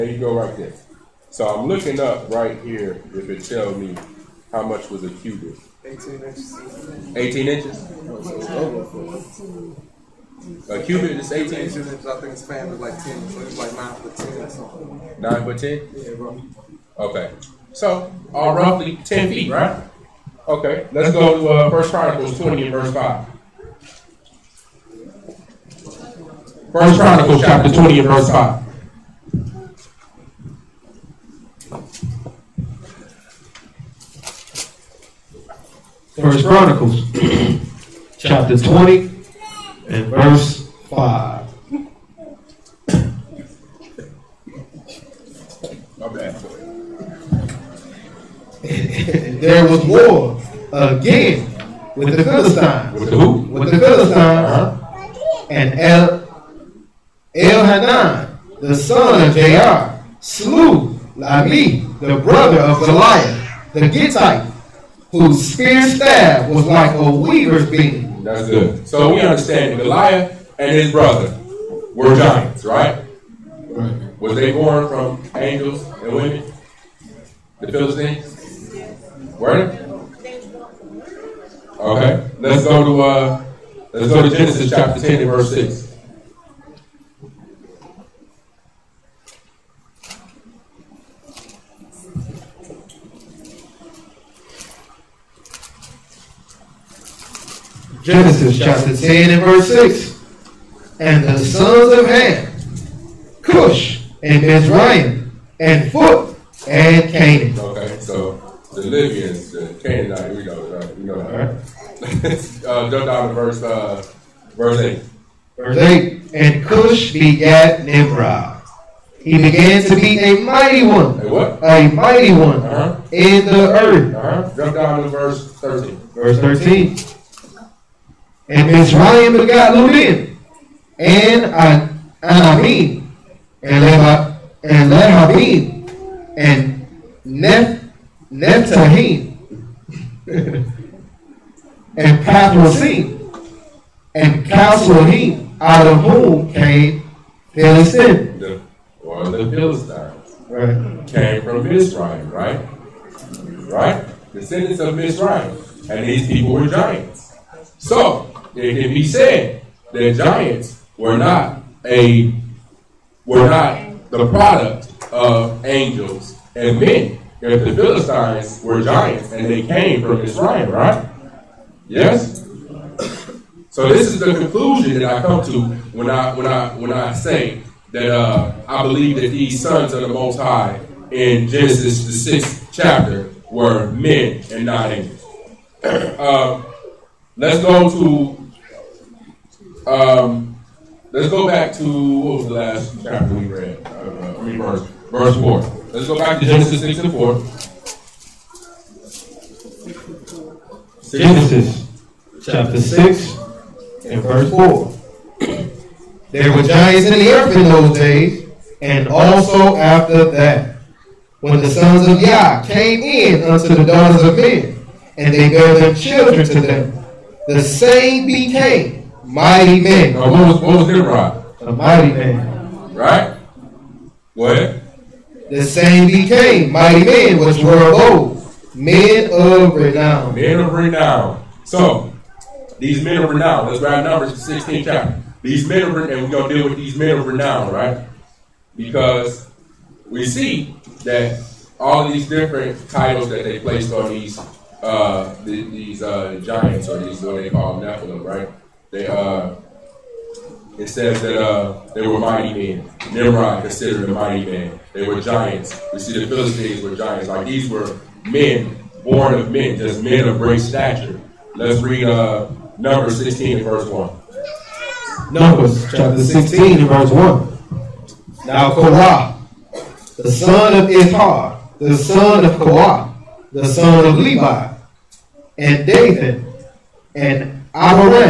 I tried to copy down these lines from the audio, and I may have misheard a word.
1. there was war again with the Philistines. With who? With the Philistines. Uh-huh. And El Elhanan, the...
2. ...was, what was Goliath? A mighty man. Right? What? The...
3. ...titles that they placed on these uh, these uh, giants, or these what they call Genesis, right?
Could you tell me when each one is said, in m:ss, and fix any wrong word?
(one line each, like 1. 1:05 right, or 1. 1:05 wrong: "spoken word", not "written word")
1. 0:49 right
2. 3:40 wrong: "Nimrod", not "Goliath"
3. 4:02 wrong: "Nephilim", not "Genesis".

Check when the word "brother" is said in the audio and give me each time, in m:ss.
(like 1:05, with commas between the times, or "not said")
1:02, 1:10.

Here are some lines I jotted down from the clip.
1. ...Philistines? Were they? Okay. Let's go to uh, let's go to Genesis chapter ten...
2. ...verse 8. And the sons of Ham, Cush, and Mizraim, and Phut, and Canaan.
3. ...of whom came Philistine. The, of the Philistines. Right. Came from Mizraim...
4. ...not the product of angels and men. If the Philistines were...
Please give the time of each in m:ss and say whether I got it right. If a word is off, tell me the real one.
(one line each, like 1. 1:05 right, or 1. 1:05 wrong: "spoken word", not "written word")
1. 1:17 right
2. 1:39 wrong: "6", not "8"
3. 2:25 right
4. 2:43 right.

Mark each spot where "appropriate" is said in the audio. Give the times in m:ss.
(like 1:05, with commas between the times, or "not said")
not said.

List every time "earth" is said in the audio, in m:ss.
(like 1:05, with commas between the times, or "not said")
2:03, 3:27.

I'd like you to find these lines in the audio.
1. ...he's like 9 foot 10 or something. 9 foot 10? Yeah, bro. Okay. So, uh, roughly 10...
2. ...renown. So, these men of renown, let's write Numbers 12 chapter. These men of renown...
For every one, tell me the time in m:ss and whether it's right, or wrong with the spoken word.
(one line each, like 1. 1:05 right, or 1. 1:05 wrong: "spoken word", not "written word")
1. 0:13 right
2. 3:50 wrong: "16", not "12".